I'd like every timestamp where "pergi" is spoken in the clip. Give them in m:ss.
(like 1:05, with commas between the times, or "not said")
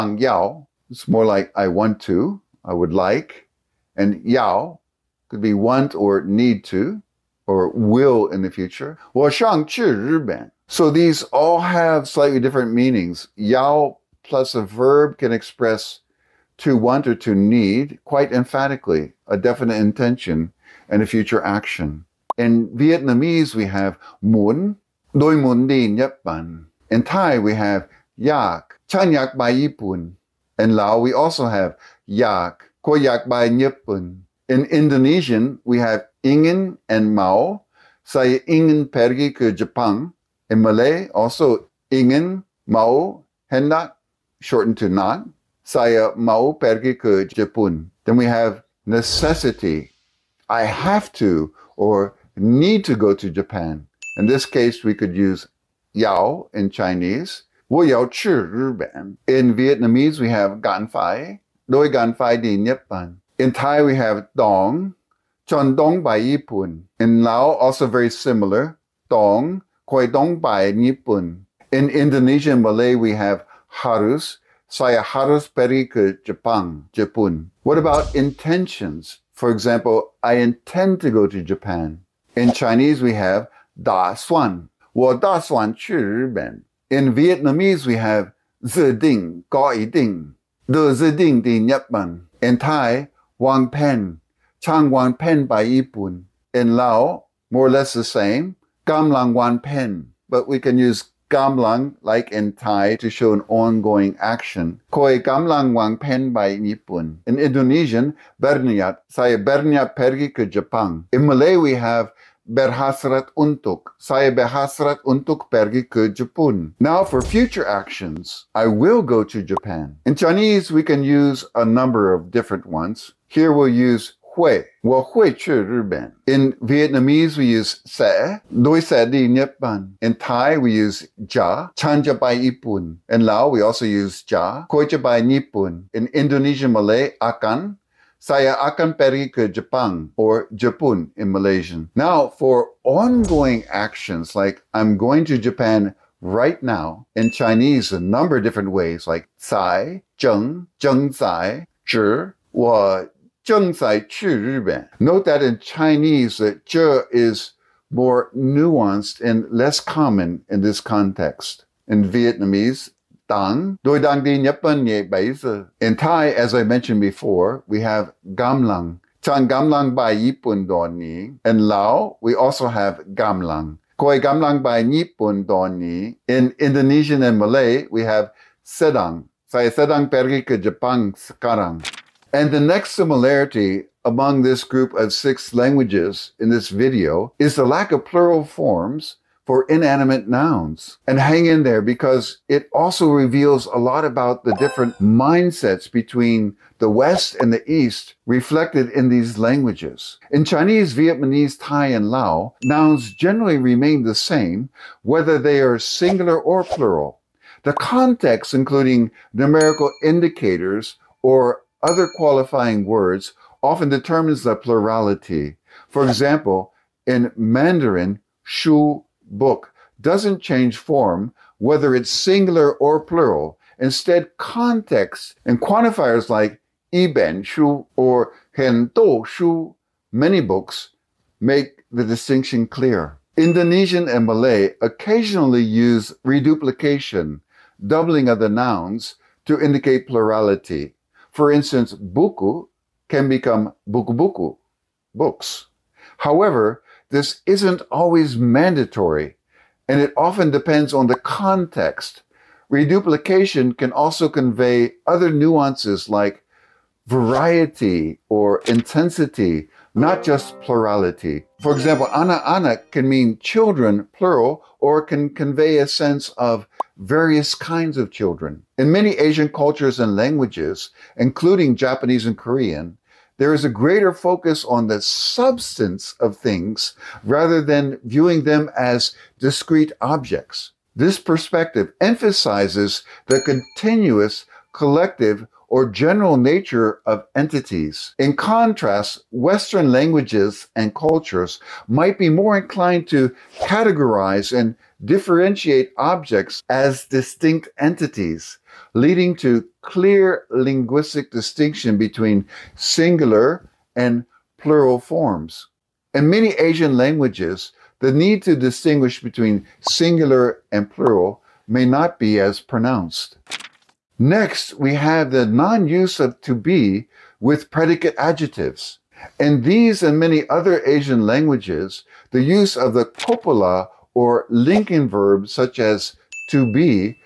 0:38, 0:46, 1:15, 1:49, 1:55, 2:18, 3:00.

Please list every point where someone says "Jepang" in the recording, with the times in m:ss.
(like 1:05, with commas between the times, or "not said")
0:39, 1:16, 1:50, 2:19, 3:00.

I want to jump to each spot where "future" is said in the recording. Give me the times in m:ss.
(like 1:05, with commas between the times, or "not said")
0:08, 0:21, 1:57.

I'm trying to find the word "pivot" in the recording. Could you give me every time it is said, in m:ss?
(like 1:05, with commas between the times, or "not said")
not said.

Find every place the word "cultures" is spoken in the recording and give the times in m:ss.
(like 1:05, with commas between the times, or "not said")
4:29, 4:50.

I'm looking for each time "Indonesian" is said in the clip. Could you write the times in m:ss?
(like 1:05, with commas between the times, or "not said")
0:34, 1:11, 1:47, 2:16, 2:56, 3:53.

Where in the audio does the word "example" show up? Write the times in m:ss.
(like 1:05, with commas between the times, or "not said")
1:19, 3:36, 4:21.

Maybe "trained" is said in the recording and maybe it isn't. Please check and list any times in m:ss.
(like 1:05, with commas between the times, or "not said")
not said.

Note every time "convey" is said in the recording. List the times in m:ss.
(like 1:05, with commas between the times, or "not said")
4:14, 4:25.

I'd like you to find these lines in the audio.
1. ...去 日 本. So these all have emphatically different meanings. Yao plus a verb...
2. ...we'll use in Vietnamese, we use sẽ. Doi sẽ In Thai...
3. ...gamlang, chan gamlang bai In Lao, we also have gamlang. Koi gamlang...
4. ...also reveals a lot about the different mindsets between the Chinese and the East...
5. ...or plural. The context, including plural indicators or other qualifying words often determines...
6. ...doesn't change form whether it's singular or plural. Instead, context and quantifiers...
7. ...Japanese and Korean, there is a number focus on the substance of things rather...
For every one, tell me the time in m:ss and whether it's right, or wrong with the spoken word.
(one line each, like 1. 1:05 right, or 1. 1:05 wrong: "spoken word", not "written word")
1. 0:09 wrong: "slightly", not "emphatically"
2. 2:03 right
3. 2:48 right
4. 3:12 wrong: "West", not "Chinese"
5. 3:26 wrong: "numerical", not "plural"
6. 3:40 right
7. 4:31 wrong: "greater", not "number".